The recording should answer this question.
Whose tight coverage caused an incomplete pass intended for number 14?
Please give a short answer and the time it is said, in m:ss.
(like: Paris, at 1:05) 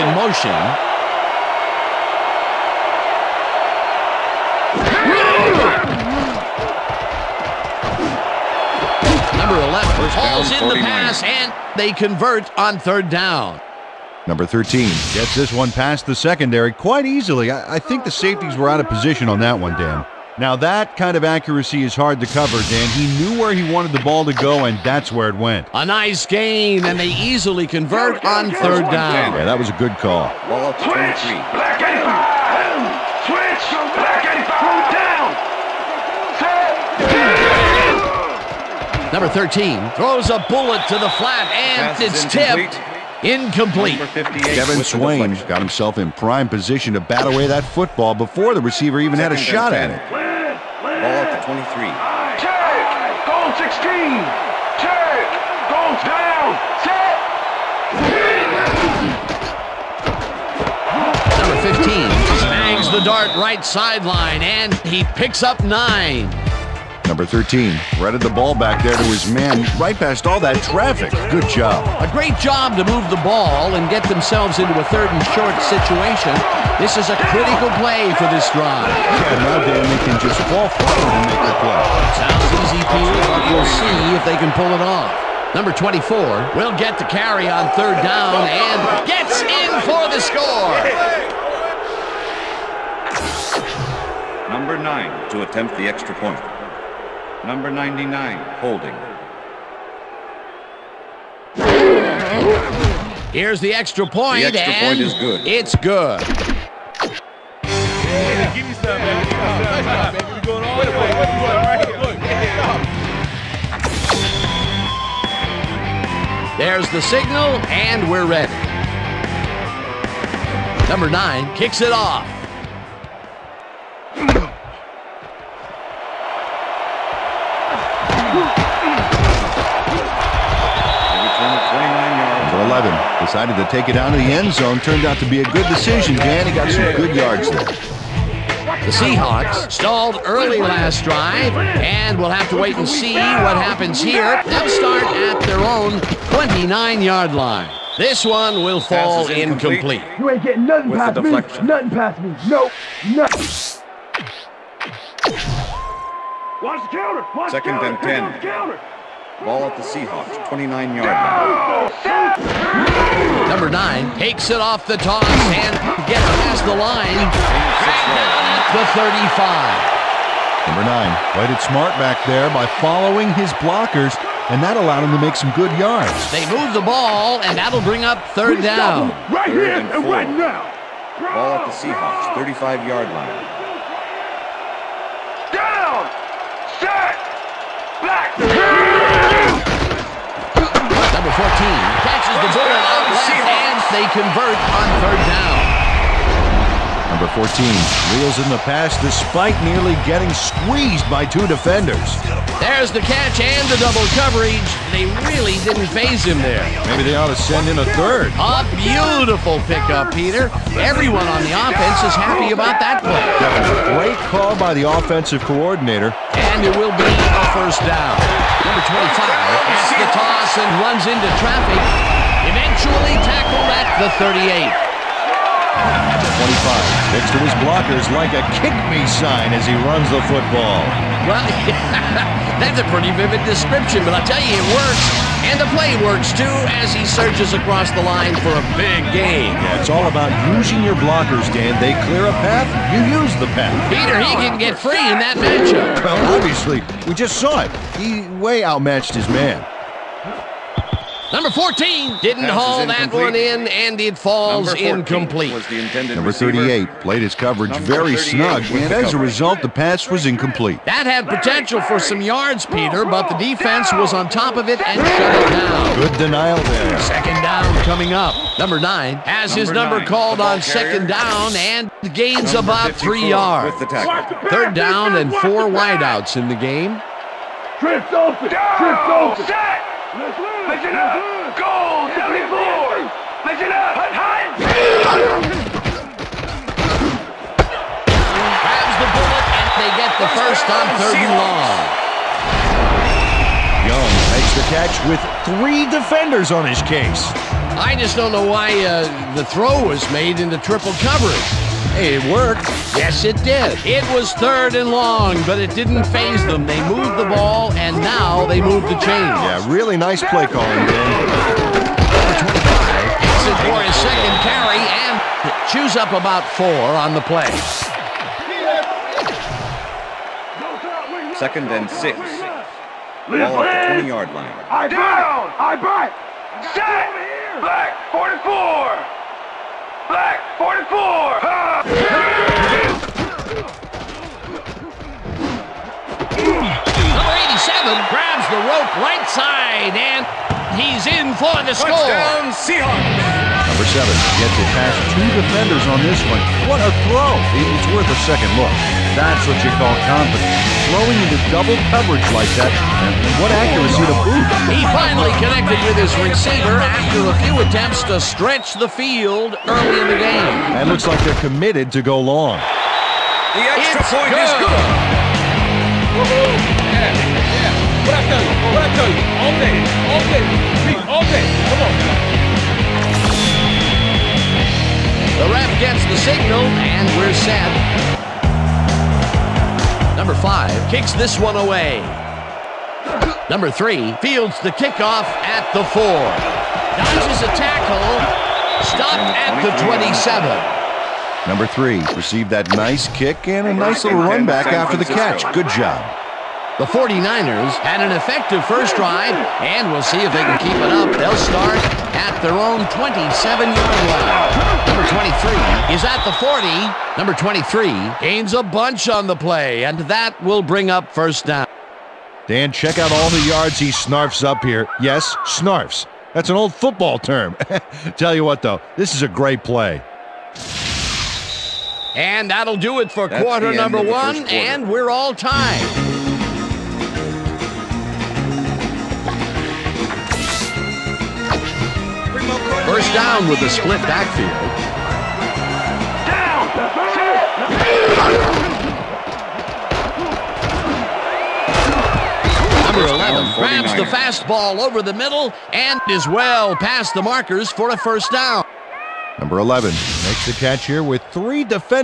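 Number 38, at 4:16.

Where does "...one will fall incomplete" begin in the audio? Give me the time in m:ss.
2:28.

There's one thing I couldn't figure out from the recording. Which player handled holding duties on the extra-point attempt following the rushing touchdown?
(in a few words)
Number 99.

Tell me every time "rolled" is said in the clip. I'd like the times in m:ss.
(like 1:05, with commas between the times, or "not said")
not said.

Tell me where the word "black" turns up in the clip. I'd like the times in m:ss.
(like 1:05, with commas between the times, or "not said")
0:31, 5:30.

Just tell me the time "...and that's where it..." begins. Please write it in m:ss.
0:24.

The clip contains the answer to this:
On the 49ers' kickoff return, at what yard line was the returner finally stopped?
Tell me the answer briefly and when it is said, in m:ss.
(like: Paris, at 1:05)
27, at 6:28.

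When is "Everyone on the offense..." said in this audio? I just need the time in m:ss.
3:30.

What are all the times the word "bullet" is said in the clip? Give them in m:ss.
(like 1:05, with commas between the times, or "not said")
0:40, 4:49.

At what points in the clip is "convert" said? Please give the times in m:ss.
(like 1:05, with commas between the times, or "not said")
0:11, 0:27, 3:14.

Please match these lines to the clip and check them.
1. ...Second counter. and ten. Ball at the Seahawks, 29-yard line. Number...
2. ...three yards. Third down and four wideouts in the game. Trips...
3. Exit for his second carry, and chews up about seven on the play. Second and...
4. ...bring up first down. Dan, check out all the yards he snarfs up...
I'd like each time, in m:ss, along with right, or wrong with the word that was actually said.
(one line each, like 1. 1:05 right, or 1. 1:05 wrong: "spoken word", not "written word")
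1. 2:37 right
2. 4:32 right
3. 5:13 wrong: "four", not "seven"
4. 6:50 right.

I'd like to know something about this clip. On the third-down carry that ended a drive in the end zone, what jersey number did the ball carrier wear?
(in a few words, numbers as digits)
24.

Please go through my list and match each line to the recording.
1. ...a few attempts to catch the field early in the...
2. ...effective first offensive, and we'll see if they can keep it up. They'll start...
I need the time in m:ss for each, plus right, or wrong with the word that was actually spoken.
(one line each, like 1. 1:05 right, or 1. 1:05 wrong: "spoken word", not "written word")
1. 5:57 wrong: "stretch", not "catch"
2. 6:38 wrong: "drive", not "offensive".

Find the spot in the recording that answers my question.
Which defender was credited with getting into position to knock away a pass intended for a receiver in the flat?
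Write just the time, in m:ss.
0:44.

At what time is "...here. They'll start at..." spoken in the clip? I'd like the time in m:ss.
2:23.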